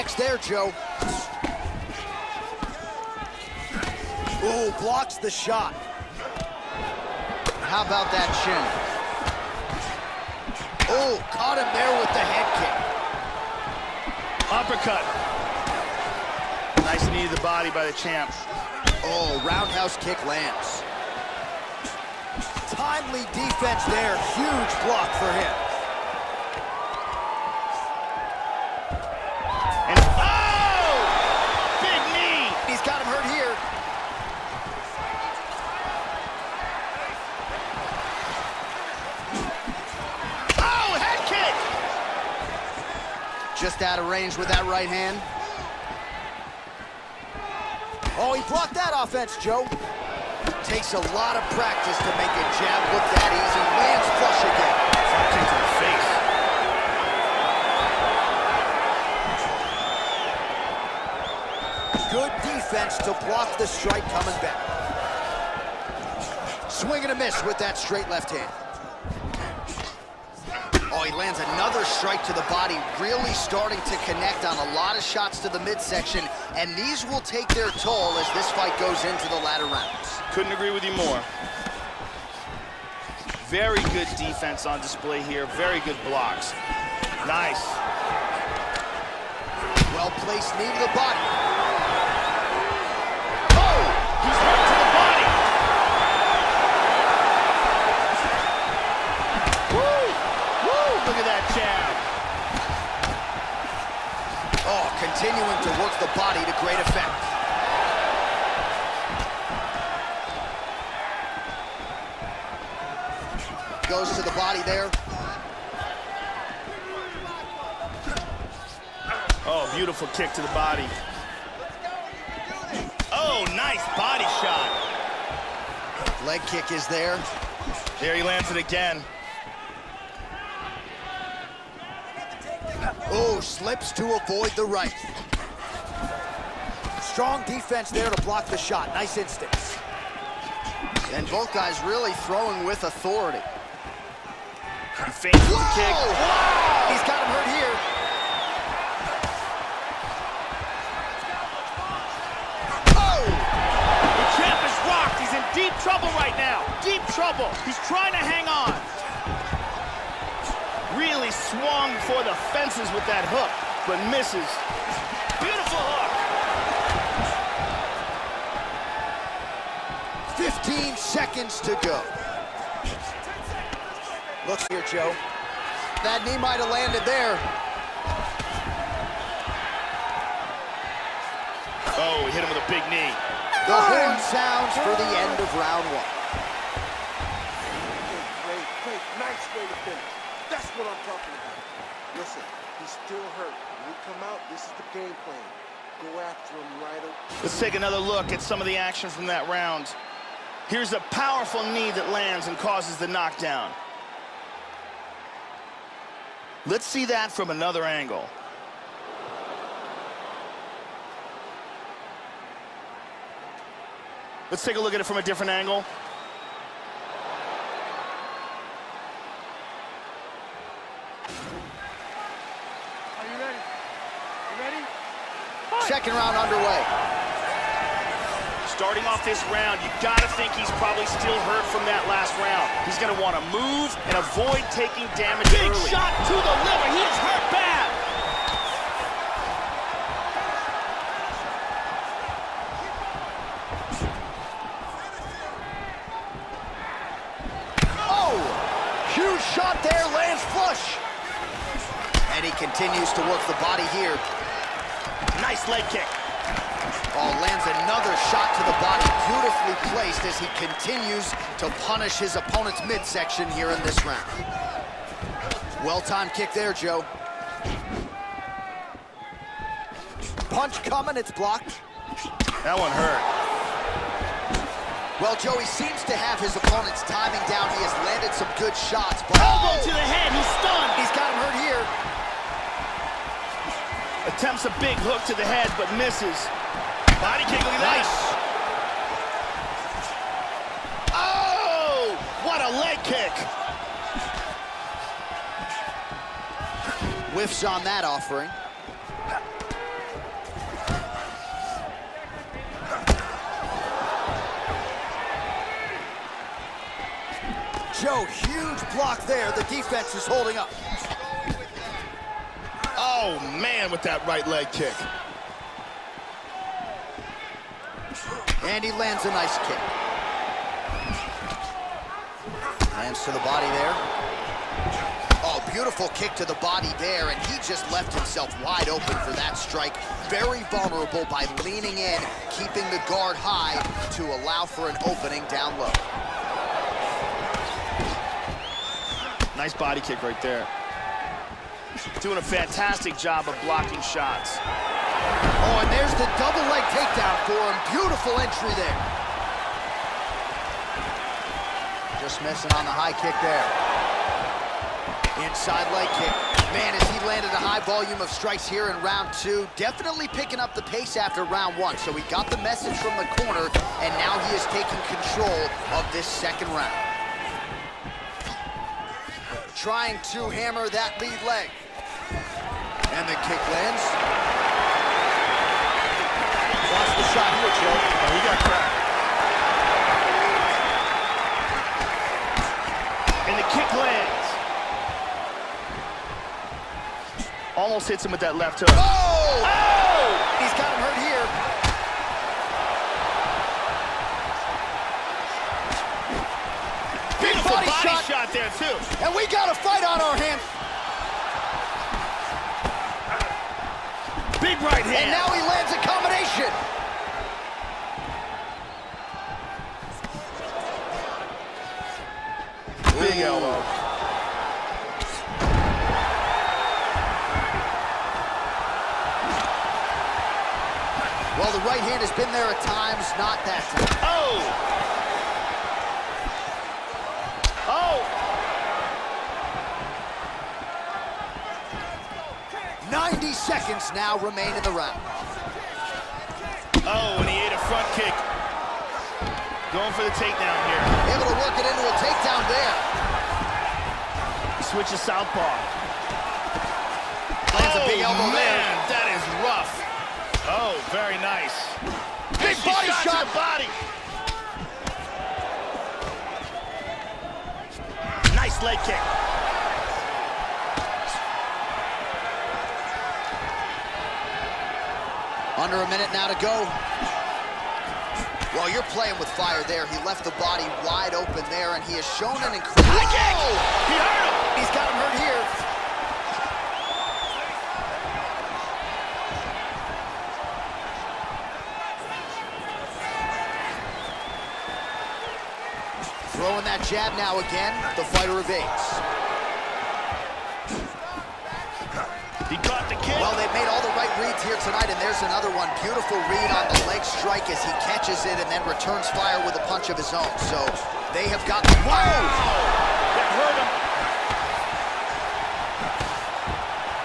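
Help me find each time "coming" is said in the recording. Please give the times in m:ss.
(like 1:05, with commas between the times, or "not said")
1:04, 4:30.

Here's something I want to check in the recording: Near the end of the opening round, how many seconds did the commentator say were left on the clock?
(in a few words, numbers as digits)
15.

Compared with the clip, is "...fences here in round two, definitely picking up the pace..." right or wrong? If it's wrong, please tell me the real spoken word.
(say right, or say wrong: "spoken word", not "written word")
wrong: "strikes", not "fences".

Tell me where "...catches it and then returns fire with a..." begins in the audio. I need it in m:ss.
8:18.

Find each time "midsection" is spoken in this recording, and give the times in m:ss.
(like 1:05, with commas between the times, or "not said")
1:15, 4:22.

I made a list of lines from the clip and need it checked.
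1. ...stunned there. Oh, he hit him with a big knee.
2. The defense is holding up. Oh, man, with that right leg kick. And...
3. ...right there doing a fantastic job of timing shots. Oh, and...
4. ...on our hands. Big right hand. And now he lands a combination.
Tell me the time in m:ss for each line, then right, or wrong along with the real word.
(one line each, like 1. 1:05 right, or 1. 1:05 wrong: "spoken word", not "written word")
1. 2:56 wrong: "landed", not "stunned"
2. 5:09 right
3. 5:40 wrong: "blocking", not "timing"
4. 6:40 right.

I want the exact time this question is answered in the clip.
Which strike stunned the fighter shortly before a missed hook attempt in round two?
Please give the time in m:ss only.
4:39.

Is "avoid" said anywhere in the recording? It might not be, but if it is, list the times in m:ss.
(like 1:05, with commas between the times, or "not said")
2:14, 3:54.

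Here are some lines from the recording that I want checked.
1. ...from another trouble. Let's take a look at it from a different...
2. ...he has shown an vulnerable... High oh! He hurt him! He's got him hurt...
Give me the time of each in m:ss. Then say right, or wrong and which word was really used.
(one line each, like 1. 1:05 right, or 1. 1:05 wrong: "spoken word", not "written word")
1. 3:27 wrong: "angle", not "trouble"
2. 7:52 wrong: "incredible", not "vulnerable".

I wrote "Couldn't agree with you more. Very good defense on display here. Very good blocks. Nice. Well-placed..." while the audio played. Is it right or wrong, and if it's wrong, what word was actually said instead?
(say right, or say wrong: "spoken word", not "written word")
right.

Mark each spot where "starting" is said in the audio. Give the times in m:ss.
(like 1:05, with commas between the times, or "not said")
1:13, 3:48.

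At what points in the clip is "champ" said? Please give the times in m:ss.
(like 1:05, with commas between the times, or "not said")
0:17, 2:34.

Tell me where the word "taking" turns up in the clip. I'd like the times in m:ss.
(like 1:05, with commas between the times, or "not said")
3:54, 6:04.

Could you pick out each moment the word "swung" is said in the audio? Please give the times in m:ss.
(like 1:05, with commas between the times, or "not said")
2:41.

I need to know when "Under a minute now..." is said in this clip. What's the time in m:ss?
7:45.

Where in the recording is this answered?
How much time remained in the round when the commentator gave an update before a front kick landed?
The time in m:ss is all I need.
7:13.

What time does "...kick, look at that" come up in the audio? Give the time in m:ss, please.
4:47.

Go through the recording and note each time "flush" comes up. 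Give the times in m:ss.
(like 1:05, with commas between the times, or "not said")
0:54, 4:10.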